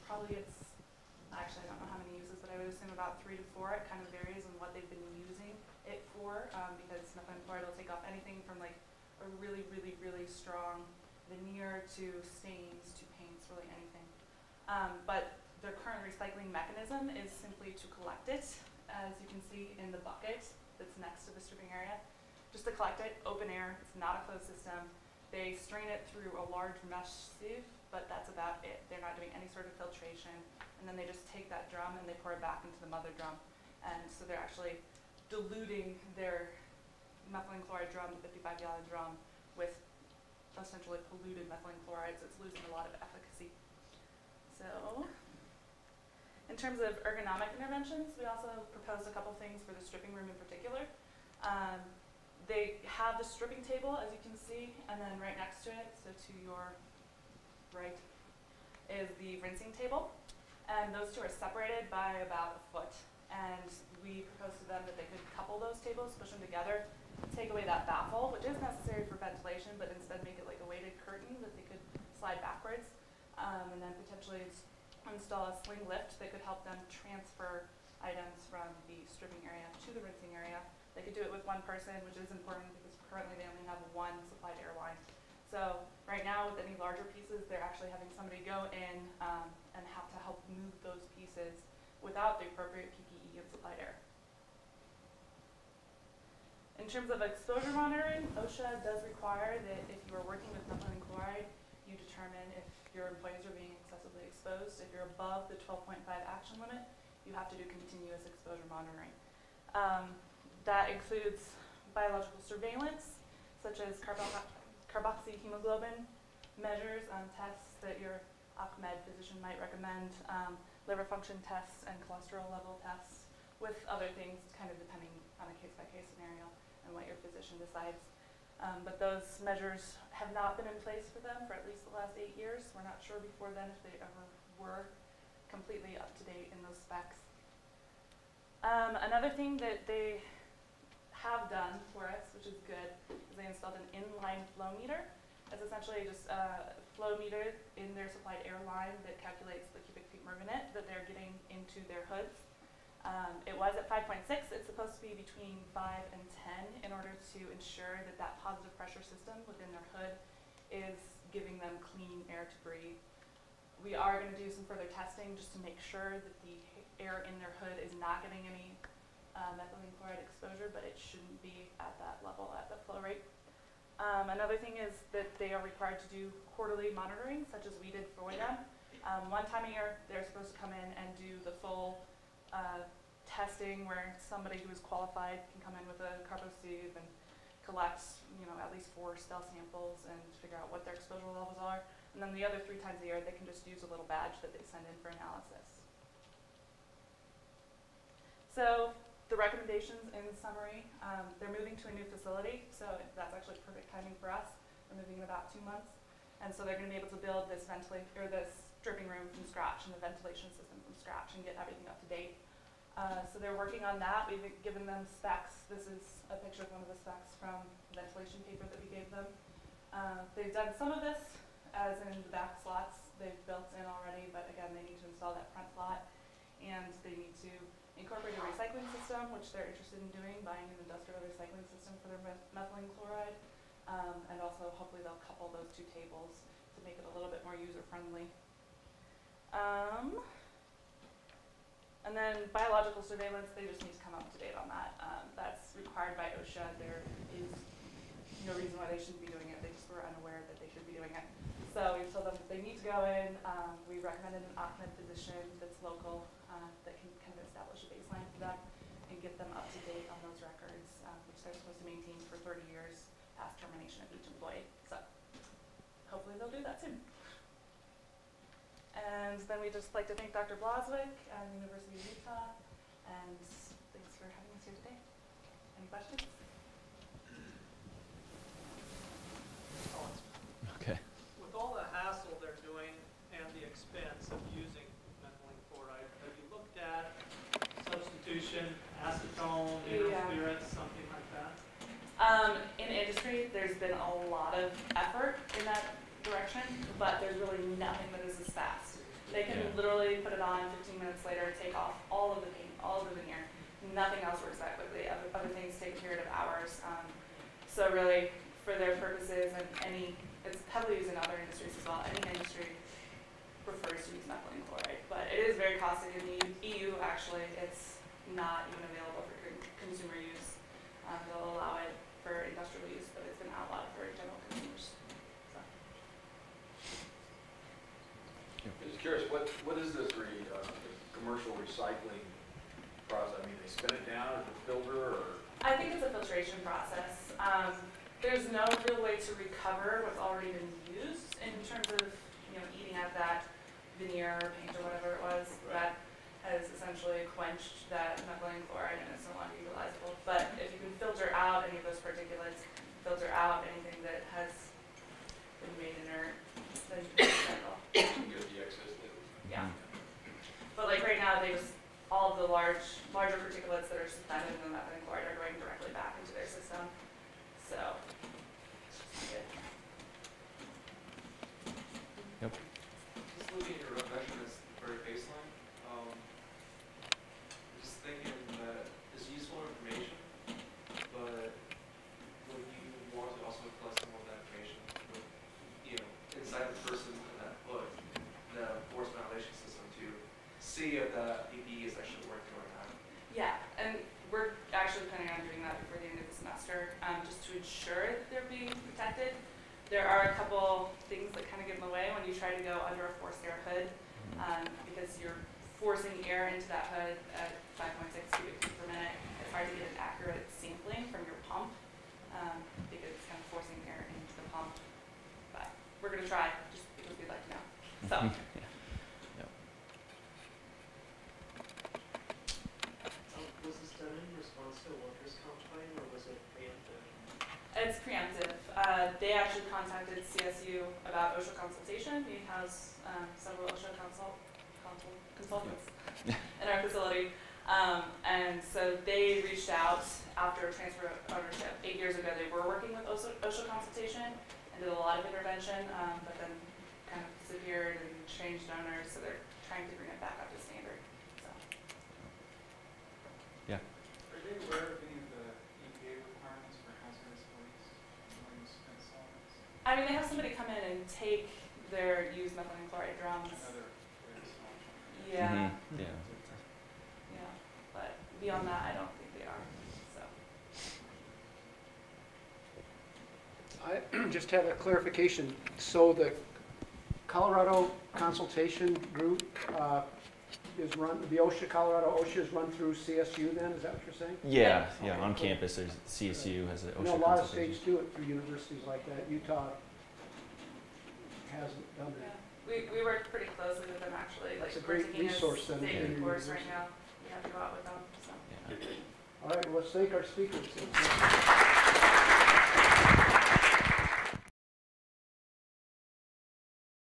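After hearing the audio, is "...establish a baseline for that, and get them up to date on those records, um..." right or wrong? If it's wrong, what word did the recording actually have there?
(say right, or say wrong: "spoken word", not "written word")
right.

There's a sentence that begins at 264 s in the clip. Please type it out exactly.
So hopefully they'll do that soon.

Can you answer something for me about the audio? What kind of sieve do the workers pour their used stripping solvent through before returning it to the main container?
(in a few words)
large mesh sieve.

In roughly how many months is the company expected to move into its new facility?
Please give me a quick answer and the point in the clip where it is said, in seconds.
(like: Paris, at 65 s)
2 months, at 205 s.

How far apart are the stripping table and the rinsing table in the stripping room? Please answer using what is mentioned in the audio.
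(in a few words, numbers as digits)
about a foot.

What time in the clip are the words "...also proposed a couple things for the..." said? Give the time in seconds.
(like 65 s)
48 s.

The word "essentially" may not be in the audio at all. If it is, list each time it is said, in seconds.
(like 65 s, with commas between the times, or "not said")
40 s, 145 s, 346 s.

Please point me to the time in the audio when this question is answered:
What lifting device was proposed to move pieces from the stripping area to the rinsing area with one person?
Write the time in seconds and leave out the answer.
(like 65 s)
75 s.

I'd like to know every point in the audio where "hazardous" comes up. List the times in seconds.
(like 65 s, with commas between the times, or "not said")
456 s.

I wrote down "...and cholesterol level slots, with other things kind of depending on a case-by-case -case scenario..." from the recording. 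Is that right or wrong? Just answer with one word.
wrong.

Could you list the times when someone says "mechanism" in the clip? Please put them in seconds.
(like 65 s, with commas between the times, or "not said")
16 s.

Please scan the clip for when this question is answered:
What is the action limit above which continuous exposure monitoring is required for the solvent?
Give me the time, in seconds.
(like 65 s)
105 s.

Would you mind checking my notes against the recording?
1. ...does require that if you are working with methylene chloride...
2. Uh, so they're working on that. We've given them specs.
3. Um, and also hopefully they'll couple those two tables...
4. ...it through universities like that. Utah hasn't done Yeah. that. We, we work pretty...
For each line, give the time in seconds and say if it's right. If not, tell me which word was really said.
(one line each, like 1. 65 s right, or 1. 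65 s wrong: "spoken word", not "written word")
1. 98 s right
2. 212 s right
3. 233 s right
4. 487 s right.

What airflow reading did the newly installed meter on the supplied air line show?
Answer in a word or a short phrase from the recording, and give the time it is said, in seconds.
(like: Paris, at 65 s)
5.6, at 153 s.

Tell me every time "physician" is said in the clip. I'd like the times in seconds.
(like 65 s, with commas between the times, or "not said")
119 s, 127 s, 254 s.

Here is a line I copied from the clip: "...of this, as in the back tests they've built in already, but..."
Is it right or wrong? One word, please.
wrong.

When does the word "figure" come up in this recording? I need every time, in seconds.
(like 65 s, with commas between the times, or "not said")
190 s.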